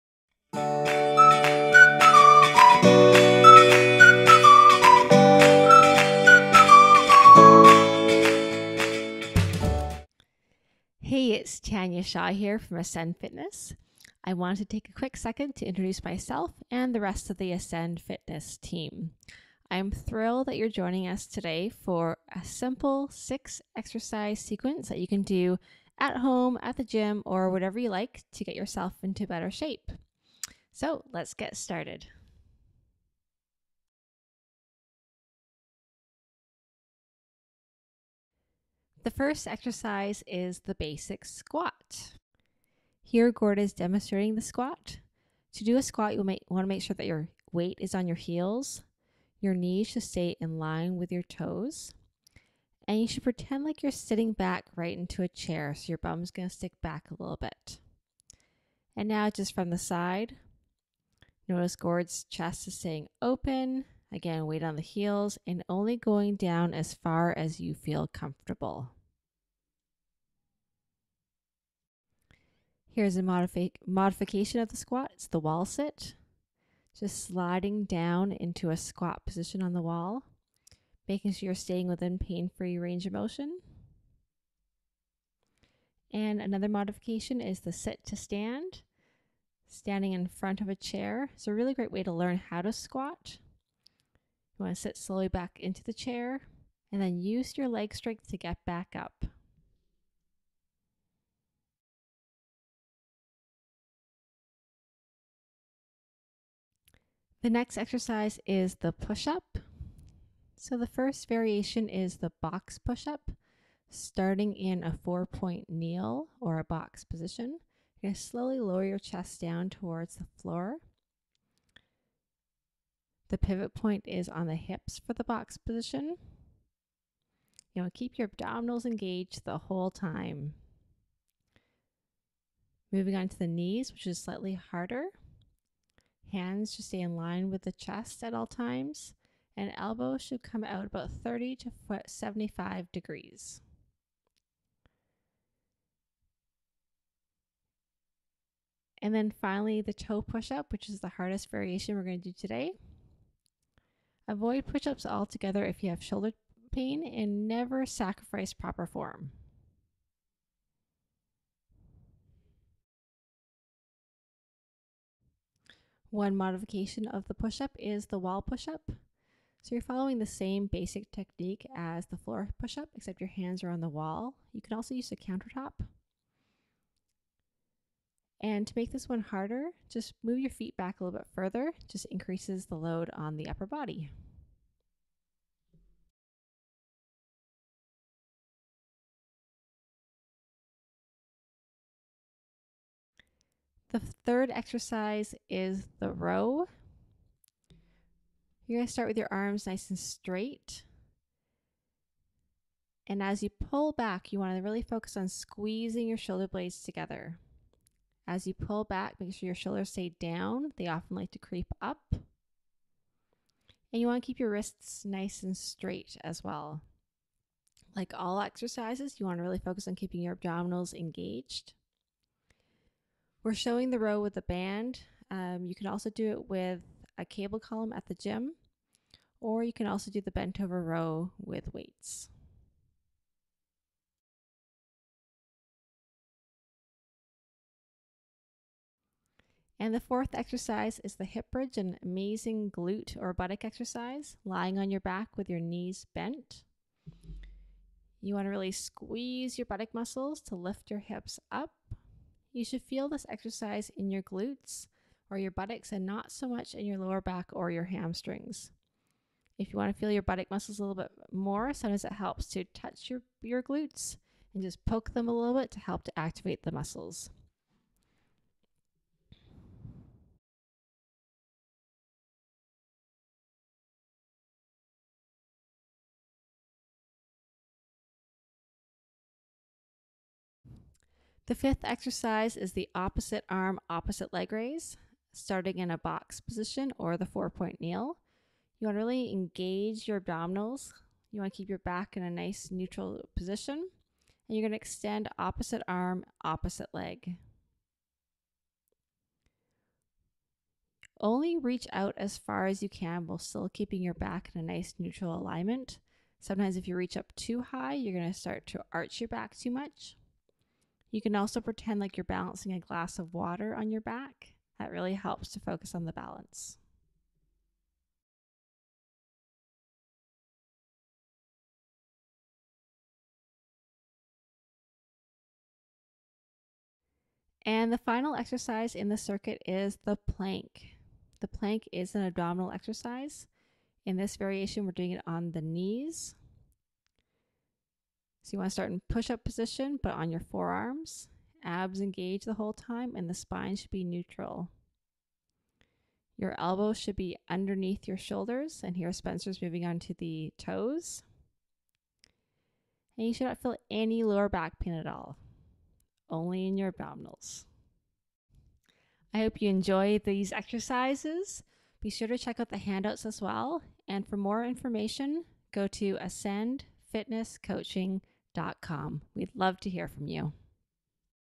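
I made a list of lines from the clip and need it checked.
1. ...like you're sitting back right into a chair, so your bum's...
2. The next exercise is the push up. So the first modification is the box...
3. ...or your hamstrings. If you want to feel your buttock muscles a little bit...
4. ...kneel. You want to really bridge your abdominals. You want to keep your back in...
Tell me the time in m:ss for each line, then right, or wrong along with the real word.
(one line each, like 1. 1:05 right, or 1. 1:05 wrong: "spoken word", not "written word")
1. 0:53 right
2. 1:47 wrong: "variation", not "modification"
3. 4:17 right
4. 4:47 wrong: "engage", not "bridge".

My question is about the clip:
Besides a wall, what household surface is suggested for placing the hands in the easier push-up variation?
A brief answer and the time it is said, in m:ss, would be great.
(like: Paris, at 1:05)
countertop, at 2:55.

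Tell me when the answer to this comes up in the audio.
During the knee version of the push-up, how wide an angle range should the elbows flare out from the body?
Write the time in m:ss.
2:21.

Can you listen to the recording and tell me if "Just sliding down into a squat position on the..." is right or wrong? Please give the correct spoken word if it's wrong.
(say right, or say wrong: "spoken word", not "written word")
right.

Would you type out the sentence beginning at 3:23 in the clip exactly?
And as you pull back, you want to really focus on squeezing your shoulder blades together.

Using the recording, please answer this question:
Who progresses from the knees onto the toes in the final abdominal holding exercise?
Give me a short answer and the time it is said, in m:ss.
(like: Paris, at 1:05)
Spencer, at 5:49.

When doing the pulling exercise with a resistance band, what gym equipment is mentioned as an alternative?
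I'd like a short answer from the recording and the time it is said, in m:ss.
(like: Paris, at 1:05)
cable column, at 3:47.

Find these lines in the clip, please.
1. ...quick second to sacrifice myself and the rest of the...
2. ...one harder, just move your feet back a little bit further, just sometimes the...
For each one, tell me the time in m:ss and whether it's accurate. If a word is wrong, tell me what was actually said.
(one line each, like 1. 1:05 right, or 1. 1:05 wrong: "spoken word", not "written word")
1. 0:14 wrong: "introduce", not "sacrifice"
2. 2:59 wrong: "increases", not "sometimes".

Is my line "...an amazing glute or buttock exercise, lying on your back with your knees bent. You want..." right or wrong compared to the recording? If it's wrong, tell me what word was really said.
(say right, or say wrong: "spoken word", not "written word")
right.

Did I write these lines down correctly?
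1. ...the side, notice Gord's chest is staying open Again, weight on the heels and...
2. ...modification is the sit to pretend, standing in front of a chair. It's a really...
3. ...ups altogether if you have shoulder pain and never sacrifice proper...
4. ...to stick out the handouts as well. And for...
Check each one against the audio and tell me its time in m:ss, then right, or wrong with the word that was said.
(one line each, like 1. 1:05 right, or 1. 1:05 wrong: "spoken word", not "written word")
1. 0:59 right
2. 1:26 wrong: "stand", not "pretend"
3. 2:34 right
4. 6:02 wrong: "check", not "stick".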